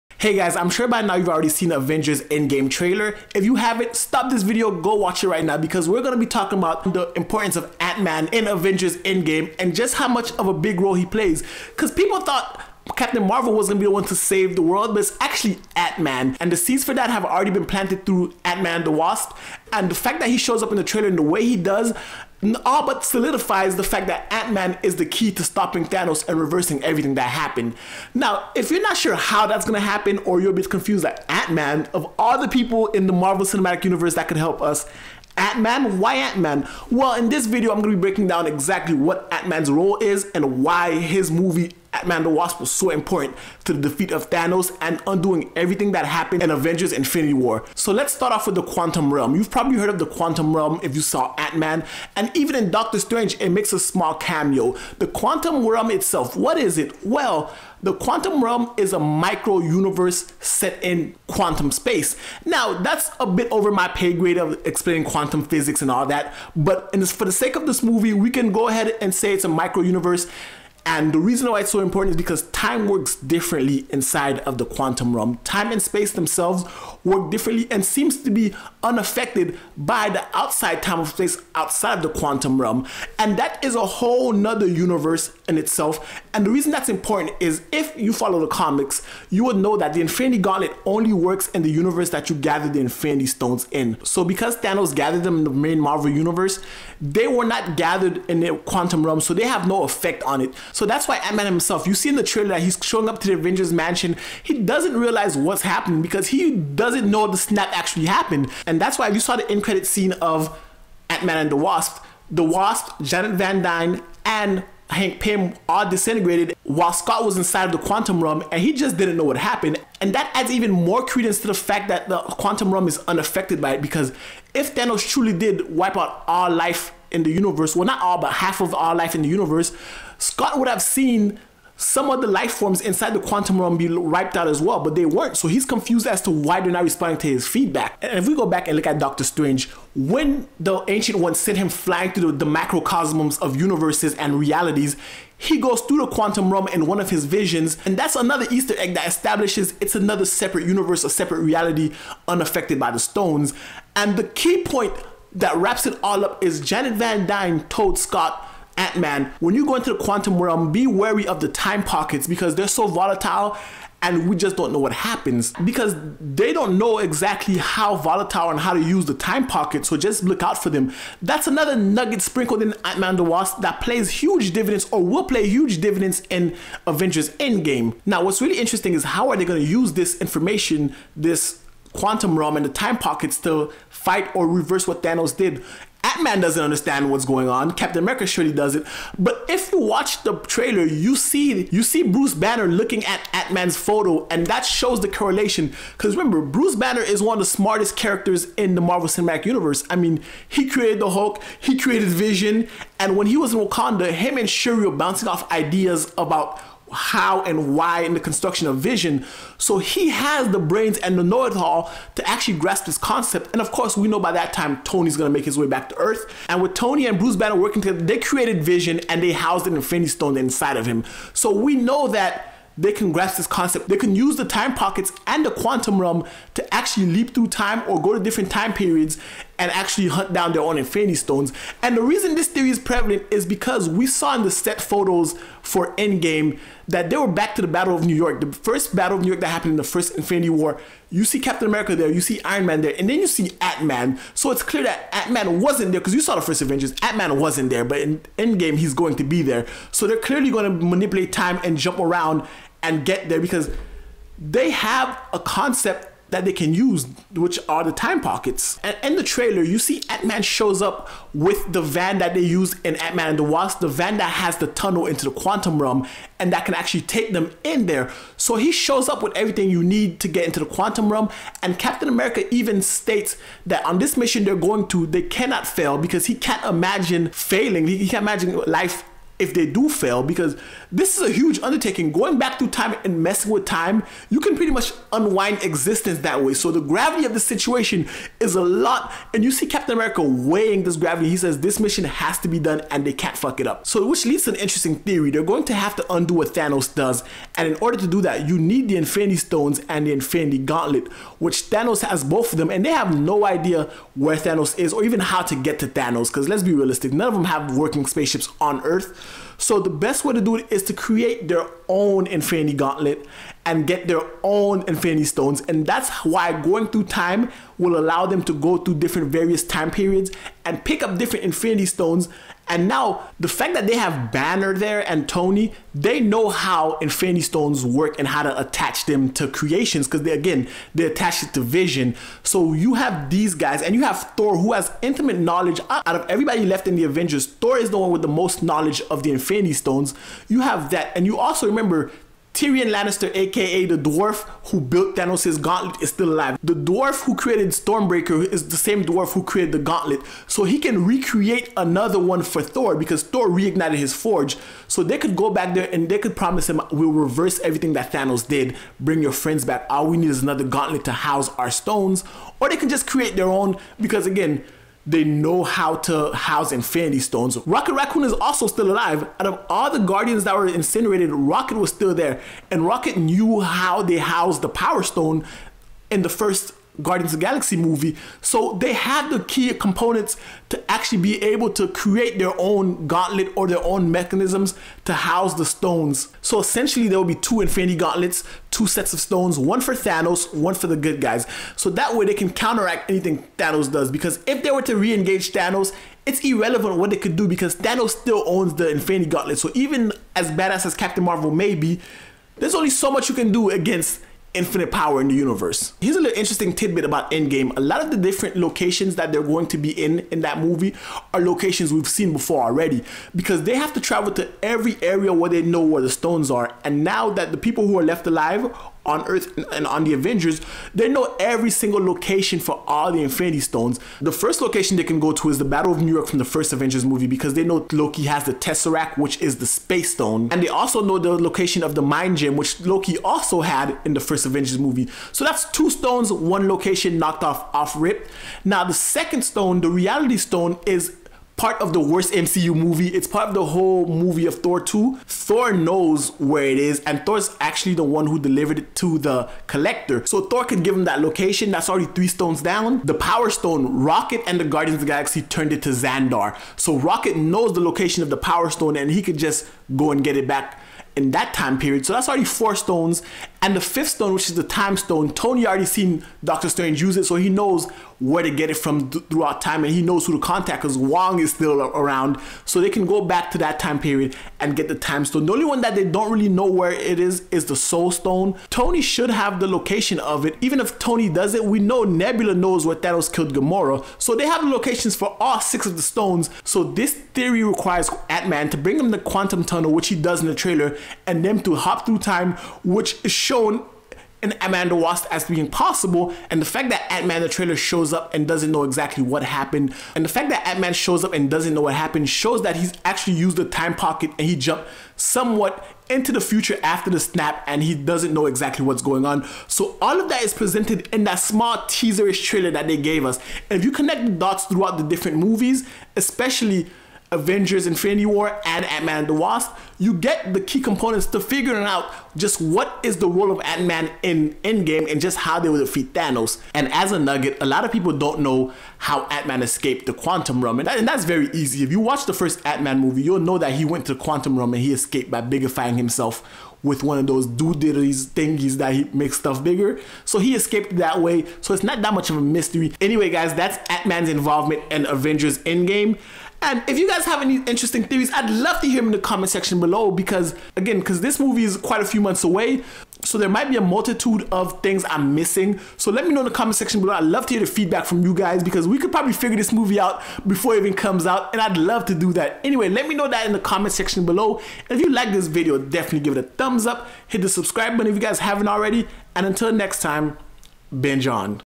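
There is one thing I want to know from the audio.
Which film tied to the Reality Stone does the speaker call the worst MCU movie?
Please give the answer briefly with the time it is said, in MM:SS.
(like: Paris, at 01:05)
Thor 2, at 07:24.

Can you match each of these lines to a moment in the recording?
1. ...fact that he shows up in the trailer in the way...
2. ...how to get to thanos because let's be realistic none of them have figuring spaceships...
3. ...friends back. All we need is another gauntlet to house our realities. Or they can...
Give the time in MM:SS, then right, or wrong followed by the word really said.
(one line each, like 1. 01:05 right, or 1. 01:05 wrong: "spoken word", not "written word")
1. 00:19 right
2. 05:05 wrong: "working", not "figuring"
3. 05:59 wrong: "stones", not "realities".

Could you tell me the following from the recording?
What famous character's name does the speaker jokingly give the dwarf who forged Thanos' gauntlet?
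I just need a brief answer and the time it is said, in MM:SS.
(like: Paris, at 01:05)
Tyrion Lannister, at 05:42.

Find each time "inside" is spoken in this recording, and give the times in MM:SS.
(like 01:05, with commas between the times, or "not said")
01:13, 01:57, 02:12, 03:40.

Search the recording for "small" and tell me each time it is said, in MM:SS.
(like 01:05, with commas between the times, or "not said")
00:53, 08:31.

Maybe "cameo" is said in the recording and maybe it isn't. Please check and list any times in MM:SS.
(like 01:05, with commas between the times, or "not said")
00:54.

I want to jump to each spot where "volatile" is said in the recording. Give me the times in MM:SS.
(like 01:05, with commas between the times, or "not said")
02:42, 02:47.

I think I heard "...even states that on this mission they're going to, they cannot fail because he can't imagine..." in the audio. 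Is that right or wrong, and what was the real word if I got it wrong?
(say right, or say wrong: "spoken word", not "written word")
right.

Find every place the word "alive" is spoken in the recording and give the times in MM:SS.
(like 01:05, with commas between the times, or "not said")
05:46, 06:08, 06:58.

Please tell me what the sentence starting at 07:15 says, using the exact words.
So that's two stones, one location knocked off off rip.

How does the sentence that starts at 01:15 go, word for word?
Time and space themselves work differently and seems to be unaffected by the outside time of space outside of the quantum realm.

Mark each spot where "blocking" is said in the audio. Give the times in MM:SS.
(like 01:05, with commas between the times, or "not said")
not said.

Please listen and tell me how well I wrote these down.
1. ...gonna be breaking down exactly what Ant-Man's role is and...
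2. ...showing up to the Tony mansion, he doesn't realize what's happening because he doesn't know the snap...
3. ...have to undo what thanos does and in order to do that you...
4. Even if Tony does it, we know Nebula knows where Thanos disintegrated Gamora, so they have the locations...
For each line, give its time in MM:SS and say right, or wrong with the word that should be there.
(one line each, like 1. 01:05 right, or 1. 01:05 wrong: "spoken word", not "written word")
1. 00:37 right
2. 01:42 wrong: "Avengers", not "Tony"
3. 04:55 right
4. 08:00 wrong: "killed", not "disintegrated".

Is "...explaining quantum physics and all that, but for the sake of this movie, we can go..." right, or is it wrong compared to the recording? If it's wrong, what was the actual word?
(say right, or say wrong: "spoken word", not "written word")
right.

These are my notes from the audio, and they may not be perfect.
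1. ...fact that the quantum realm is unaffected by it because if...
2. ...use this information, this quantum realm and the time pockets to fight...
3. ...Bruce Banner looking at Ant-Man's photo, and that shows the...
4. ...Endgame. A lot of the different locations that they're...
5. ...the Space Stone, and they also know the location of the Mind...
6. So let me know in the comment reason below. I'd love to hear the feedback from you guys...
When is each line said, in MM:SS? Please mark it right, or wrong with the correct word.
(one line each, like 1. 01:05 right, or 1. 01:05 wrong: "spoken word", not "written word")
1. 02:01 right
2. 02:59 right
3. 03:12 right
4. 06:47 right
5. 07:09 right
6. 09:15 wrong: "section", not "reason".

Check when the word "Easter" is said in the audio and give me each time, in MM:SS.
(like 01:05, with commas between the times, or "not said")
02:28.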